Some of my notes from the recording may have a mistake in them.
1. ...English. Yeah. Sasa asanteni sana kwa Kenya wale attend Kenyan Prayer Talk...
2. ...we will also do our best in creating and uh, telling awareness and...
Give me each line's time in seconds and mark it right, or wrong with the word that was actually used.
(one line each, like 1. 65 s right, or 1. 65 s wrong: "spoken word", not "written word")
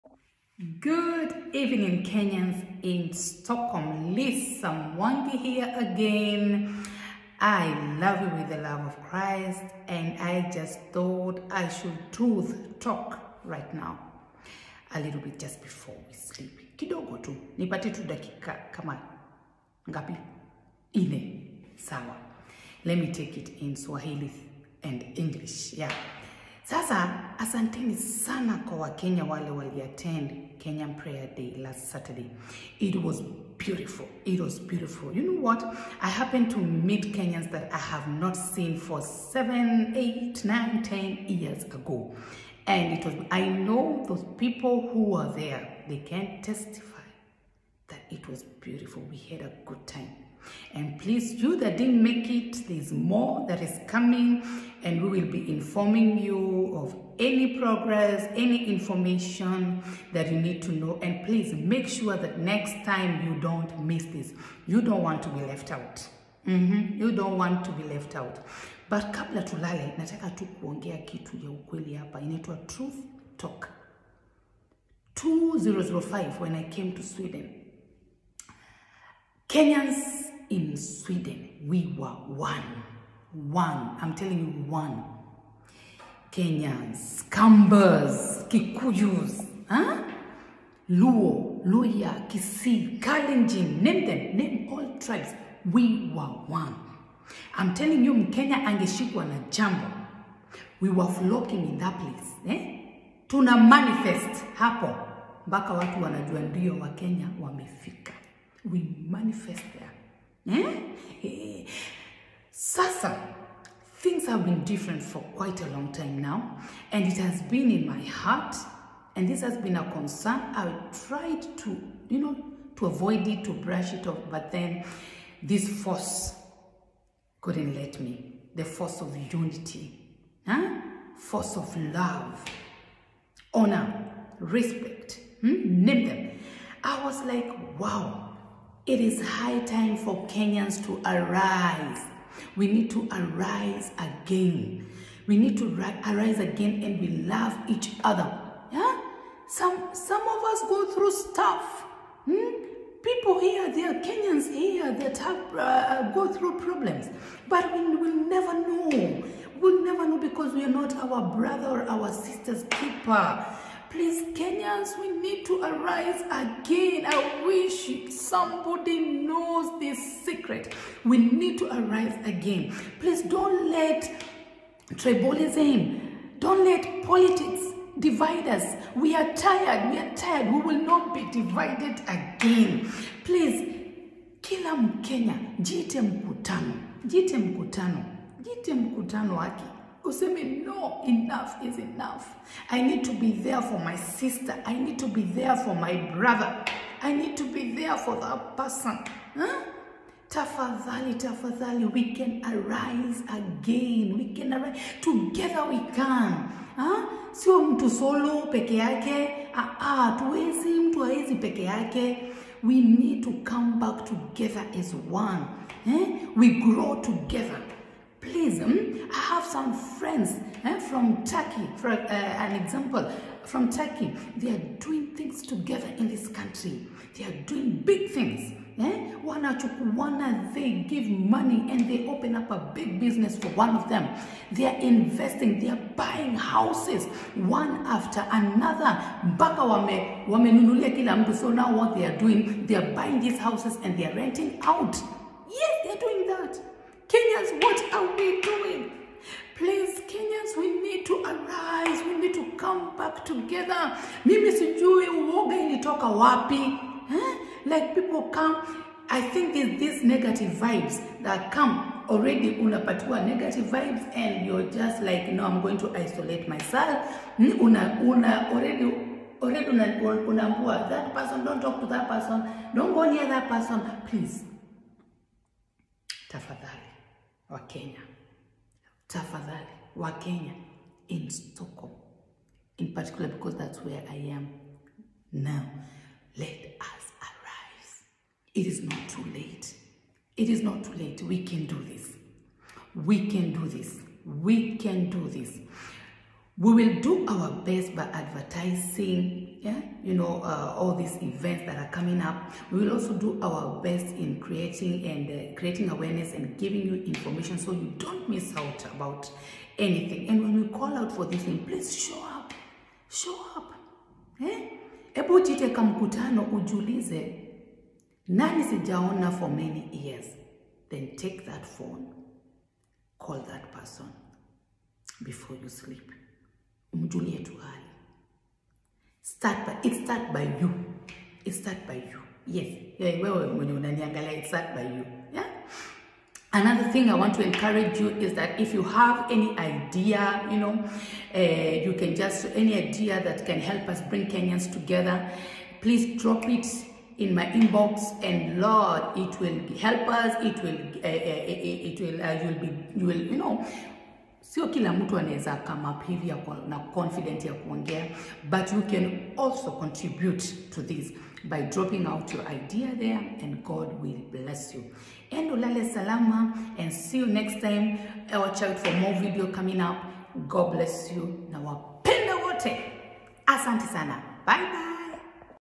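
1. 25 s wrong: "Day", not "Talk"
2. 302 s wrong: "creating", not "telling".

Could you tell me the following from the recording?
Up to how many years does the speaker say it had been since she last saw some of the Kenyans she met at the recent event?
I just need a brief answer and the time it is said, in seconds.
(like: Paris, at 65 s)
10, at 40 s.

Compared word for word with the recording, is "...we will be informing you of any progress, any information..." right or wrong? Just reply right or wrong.
right.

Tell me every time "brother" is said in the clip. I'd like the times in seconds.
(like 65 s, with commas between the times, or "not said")
161 s, 196 s.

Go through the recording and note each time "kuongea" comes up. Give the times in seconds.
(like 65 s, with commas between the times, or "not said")
70 s, 357 s.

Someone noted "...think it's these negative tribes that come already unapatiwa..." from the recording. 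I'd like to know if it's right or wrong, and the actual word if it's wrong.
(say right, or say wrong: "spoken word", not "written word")
wrong: "vibes", not "tribes".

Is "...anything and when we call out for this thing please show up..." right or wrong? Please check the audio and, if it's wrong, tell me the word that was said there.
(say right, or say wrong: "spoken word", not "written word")
right.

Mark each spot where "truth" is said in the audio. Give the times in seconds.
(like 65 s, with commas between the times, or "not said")
12 s, 72 s.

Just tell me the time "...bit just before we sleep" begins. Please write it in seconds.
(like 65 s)
15 s.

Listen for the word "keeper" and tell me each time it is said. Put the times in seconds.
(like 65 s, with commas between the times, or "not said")
162 s.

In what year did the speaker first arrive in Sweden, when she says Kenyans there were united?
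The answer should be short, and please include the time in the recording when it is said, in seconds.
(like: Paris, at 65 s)
2005, at 75 s.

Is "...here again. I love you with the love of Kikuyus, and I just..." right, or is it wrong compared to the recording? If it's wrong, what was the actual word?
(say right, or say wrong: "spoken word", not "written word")
wrong: "Christ", not "Kikuyus".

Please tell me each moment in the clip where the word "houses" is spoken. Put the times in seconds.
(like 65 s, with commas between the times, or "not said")
236 s, 243 s.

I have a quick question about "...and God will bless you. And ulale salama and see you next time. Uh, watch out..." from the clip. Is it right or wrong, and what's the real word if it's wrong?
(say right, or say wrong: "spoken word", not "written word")
right.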